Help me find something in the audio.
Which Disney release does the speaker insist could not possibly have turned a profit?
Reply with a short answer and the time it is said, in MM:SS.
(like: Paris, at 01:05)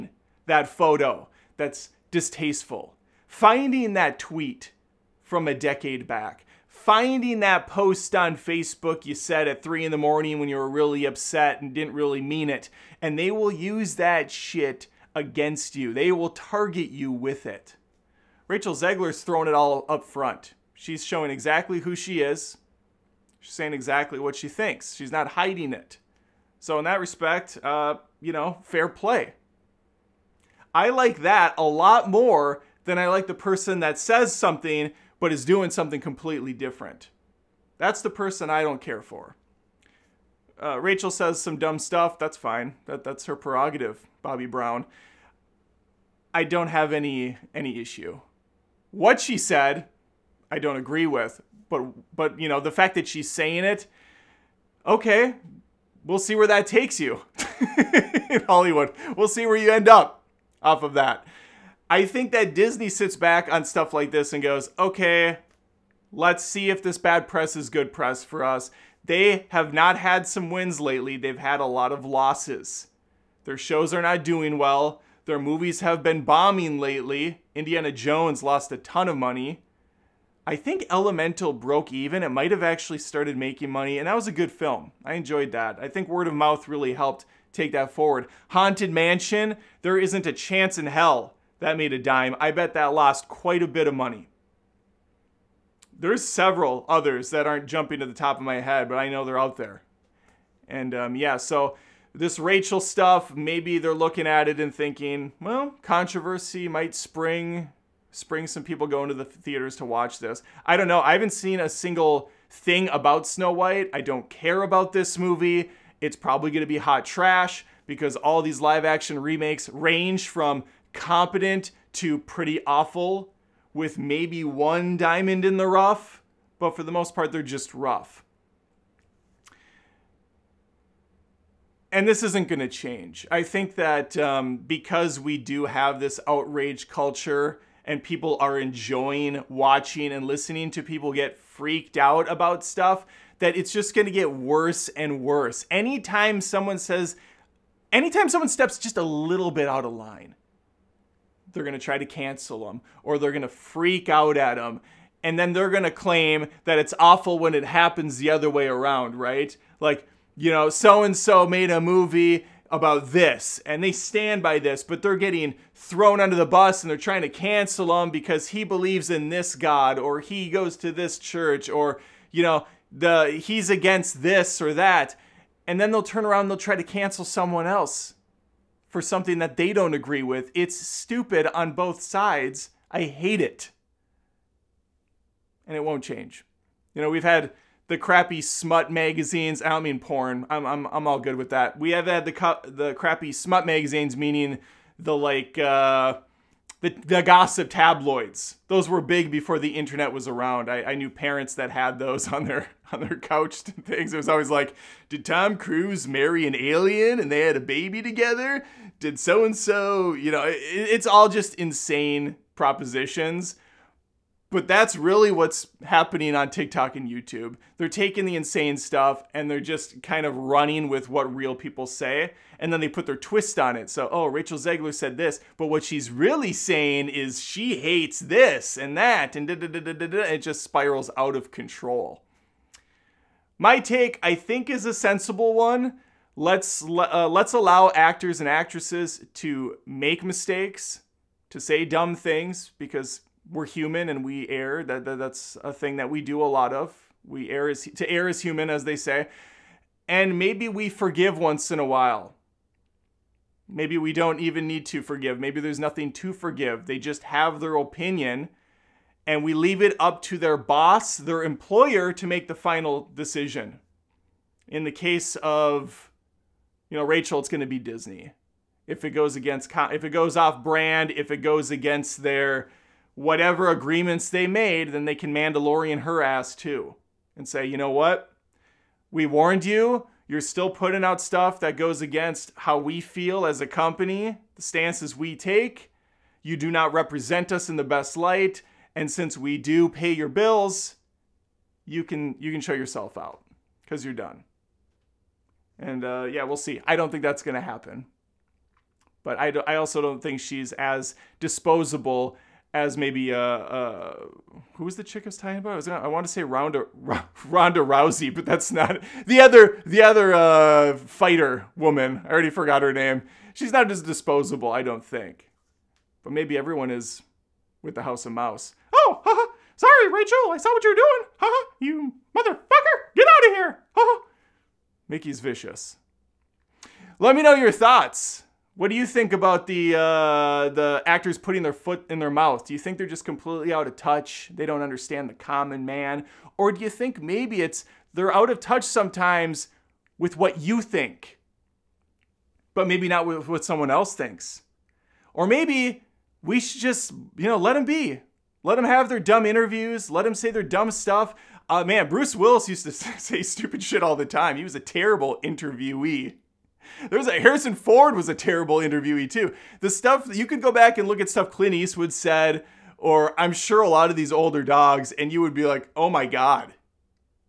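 Haunted Mansion, at 01:28.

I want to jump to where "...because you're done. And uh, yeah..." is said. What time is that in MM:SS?
04:53.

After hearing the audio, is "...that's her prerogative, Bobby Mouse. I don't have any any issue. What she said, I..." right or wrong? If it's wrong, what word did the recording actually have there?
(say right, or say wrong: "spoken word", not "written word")
wrong: "Brown", not "Mouse".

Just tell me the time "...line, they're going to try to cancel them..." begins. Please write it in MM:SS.
02:29.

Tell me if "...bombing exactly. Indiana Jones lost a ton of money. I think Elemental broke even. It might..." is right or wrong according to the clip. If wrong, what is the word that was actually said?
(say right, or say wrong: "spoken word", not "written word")
wrong: "lately", not "exactly".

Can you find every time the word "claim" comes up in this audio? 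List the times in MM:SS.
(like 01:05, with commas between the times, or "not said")
02:35.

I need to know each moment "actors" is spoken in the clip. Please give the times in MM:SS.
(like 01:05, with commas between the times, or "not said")
03:57, 05:31.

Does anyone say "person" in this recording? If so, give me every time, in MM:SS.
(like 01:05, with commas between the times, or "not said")
00:33, 00:38.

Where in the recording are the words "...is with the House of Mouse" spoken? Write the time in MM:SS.
05:16.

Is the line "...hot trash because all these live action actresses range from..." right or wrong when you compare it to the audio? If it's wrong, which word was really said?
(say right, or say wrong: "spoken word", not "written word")
wrong: "remakes", not "actresses".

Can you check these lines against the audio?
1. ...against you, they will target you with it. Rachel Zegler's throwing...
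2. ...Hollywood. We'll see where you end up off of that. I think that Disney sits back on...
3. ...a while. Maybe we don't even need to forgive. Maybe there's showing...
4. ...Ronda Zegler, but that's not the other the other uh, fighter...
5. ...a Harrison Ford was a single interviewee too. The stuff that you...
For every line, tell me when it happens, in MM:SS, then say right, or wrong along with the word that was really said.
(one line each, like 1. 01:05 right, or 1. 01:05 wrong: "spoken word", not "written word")
1. 00:15 right
2. 00:58 right
3. 04:11 wrong: "nothing", not "showing"
4. 05:07 wrong: "Rousey", not "Zegler"
5. 05:57 wrong: "terrible", not "single".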